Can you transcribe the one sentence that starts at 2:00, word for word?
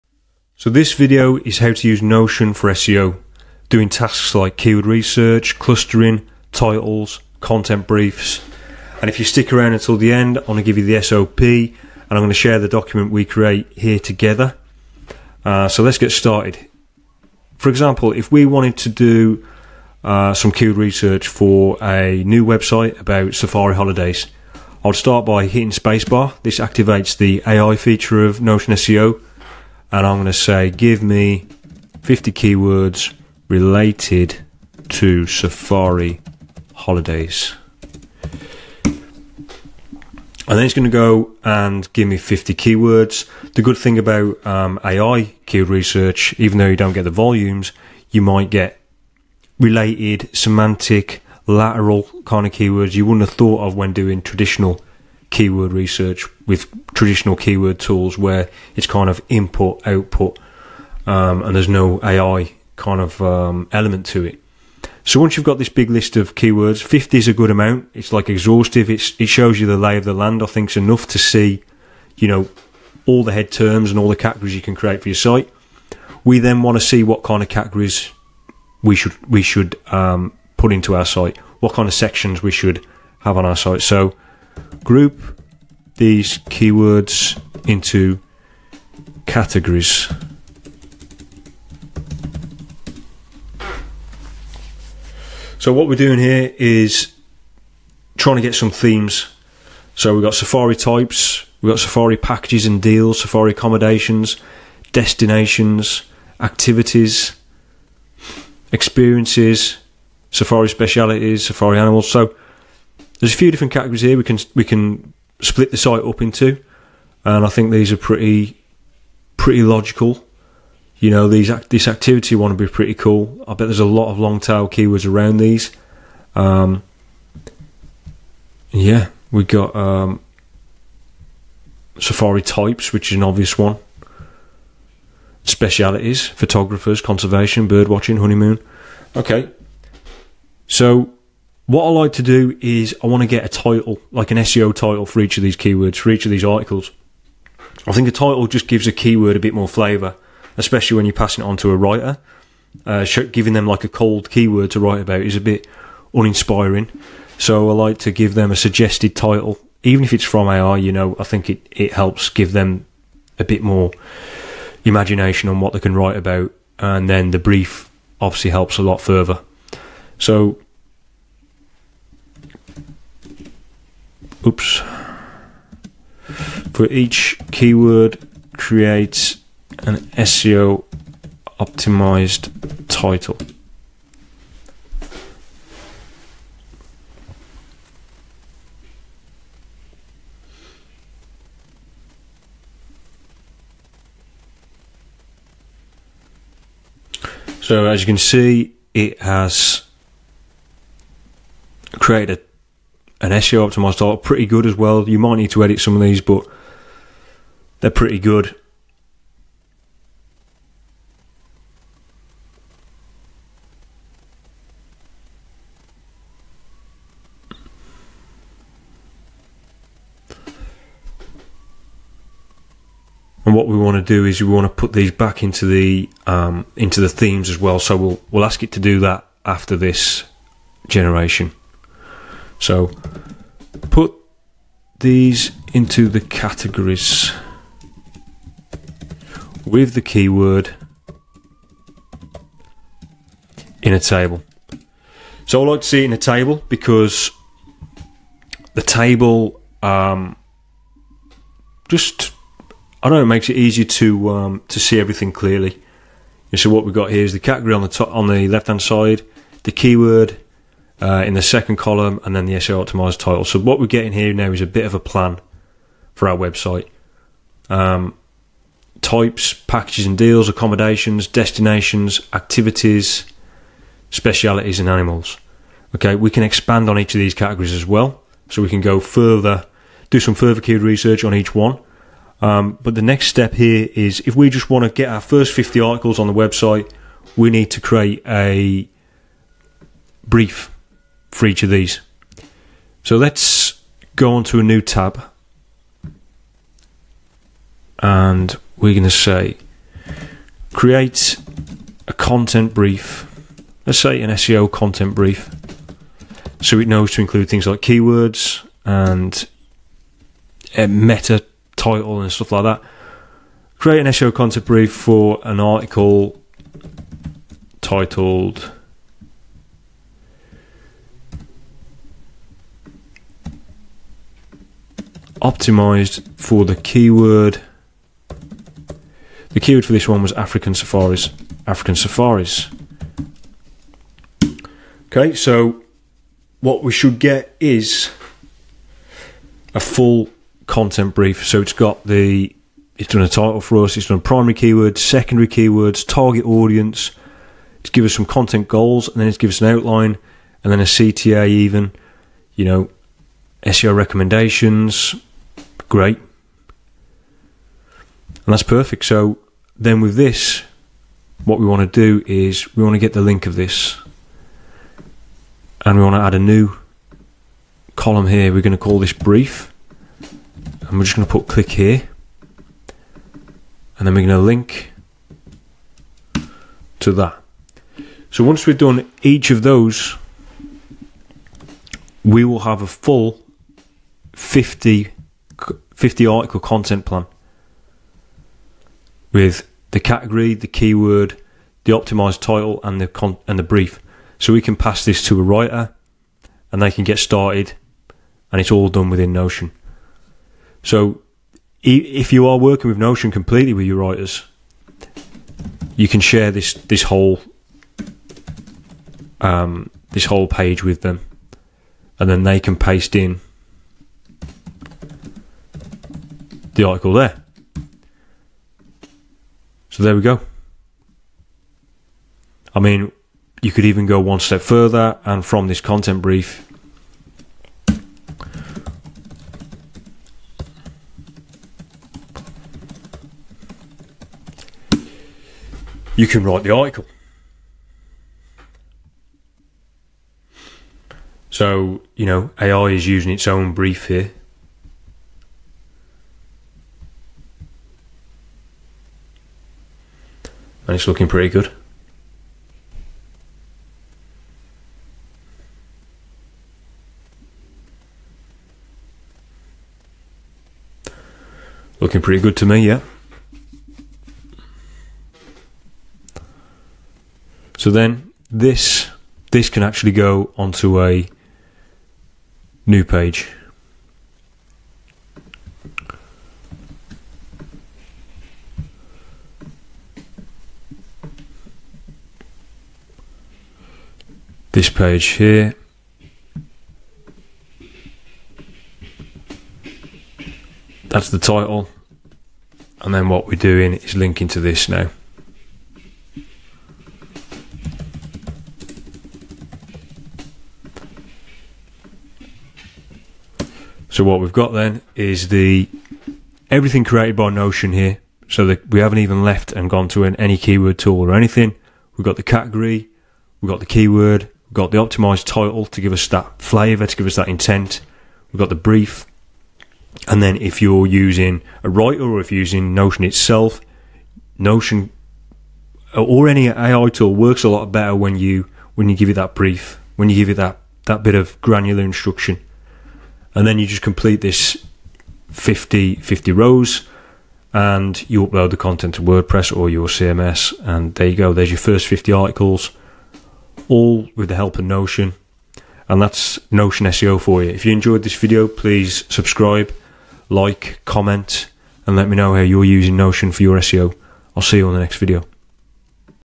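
You know, these this activity one would be pretty cool.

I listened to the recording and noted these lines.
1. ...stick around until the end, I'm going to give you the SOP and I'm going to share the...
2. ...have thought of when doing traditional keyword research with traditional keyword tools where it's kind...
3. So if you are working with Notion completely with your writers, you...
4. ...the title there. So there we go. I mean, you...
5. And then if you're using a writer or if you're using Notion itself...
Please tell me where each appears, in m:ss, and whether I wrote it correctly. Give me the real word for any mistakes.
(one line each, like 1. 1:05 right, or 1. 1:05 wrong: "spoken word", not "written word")
1. 0:09 right
2. 0:53 right
3. 6:40 right
4. 6:56 wrong: "article", not "title"
5. 8:40 right.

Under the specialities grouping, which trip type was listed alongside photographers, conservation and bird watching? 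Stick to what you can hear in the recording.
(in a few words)
Honeymoon.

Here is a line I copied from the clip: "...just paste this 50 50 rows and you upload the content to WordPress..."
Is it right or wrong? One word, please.
wrong.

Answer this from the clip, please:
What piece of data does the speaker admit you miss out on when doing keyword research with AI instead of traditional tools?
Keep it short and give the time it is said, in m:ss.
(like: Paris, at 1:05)
Volumes, at 0:47.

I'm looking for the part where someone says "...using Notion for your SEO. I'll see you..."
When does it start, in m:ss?
9:12.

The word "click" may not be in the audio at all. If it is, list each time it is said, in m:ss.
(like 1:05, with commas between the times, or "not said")
6:11.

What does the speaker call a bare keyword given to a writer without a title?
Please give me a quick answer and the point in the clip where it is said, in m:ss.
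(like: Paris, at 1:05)
Cold keyword, at 2:33.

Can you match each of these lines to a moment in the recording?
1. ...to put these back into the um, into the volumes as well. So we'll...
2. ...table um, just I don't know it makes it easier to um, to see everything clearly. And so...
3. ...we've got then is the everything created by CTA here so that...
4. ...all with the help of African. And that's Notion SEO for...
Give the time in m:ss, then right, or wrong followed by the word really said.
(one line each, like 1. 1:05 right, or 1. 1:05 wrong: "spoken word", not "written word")
1. 3:44 wrong: "themes", not "volumes"
2. 4:08 right
3. 8:24 wrong: "Notion", not "CTA"
4. 9:03 wrong: "Notion", not "African".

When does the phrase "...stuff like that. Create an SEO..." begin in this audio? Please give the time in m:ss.
5:12.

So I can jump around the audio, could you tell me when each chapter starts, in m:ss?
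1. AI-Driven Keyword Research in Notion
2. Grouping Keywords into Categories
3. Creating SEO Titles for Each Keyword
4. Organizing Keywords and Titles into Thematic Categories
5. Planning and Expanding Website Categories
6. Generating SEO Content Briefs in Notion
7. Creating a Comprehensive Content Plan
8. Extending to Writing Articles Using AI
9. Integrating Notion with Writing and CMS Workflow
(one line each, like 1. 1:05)
1. 0:42
2. 1:13
3. 1:58
4. 3:45
5. 4:30
6. 5:17
7. 6:10
8. 7:02
9. 8:10.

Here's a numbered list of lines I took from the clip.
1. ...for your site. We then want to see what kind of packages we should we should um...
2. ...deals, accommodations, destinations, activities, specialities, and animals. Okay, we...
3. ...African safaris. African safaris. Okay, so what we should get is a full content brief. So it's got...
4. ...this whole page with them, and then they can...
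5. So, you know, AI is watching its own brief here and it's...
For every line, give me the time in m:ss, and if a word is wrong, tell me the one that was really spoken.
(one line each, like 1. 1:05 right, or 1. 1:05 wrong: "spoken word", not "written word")
1. 1:15 wrong: "categories", not "packages"
2. 4:30 right
3. 5:30 right
4. 6:50 right
5. 7:21 wrong: "using", not "watching".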